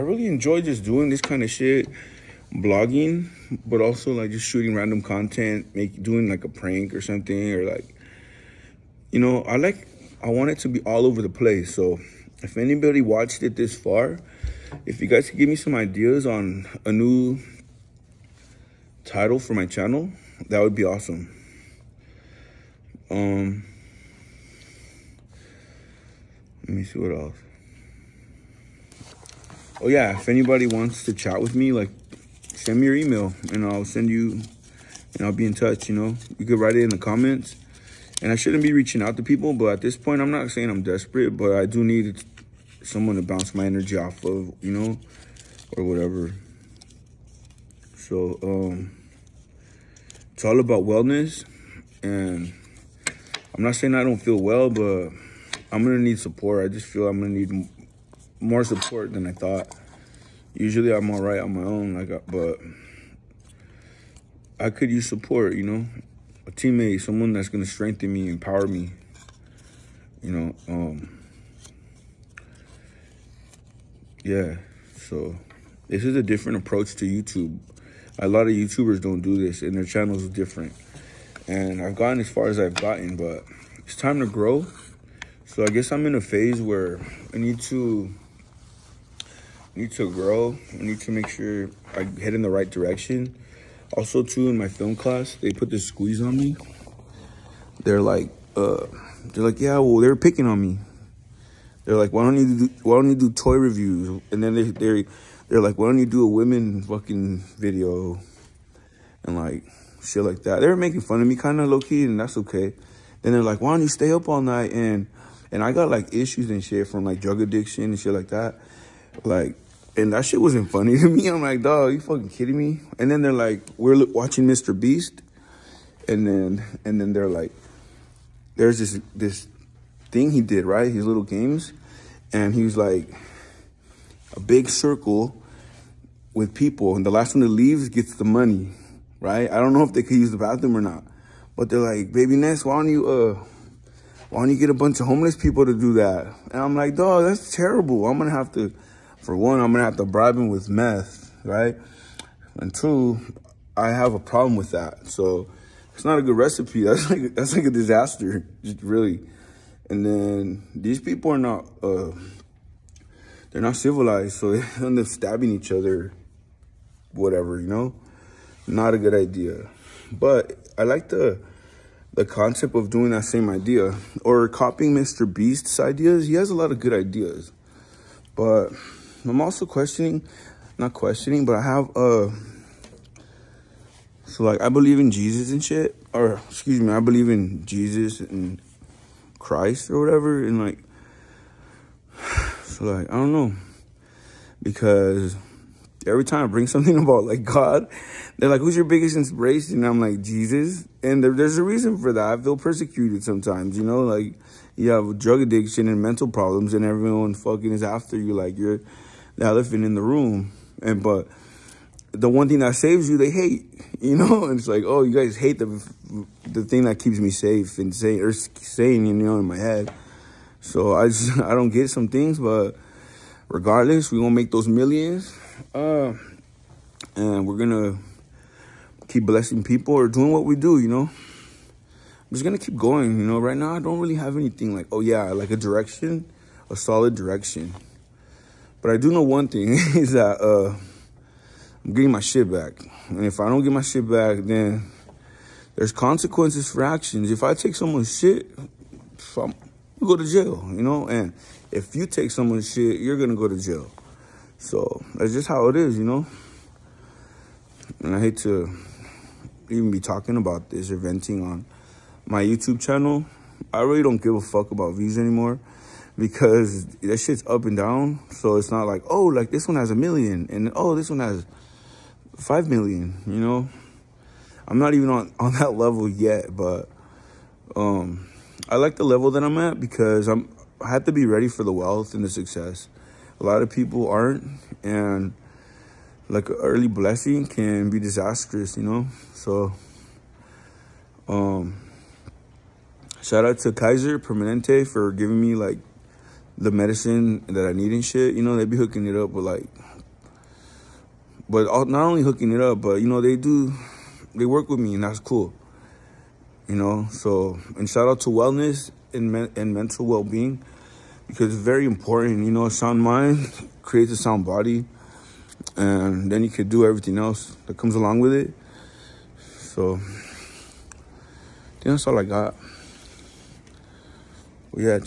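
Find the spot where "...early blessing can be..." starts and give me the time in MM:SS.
04:46.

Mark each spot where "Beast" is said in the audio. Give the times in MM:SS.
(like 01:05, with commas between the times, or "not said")
02:04, 02:55.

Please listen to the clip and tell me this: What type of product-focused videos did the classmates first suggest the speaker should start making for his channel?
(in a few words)
toy reviews.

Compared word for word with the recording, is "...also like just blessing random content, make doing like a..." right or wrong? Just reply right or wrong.
wrong.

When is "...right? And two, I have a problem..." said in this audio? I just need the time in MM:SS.
02:31.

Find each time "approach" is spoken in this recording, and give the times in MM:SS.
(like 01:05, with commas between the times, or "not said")
01:16.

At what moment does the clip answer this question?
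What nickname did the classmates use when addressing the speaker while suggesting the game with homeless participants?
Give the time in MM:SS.
02:22.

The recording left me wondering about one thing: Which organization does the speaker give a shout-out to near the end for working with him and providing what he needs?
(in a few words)
Kaiser Permanente.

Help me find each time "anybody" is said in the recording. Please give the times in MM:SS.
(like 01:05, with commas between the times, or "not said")
00:12, 00:30.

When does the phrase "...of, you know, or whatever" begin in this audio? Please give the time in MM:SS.
00:44.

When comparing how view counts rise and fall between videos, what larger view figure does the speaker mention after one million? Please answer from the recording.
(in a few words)
5 million.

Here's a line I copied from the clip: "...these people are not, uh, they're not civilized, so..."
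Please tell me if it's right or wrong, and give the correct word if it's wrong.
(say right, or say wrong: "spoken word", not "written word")
right.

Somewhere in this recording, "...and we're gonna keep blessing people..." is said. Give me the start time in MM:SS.
03:47.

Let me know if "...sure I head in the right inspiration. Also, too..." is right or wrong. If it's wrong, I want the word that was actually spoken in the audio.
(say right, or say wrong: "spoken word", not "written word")
wrong: "direction", not "inspiration".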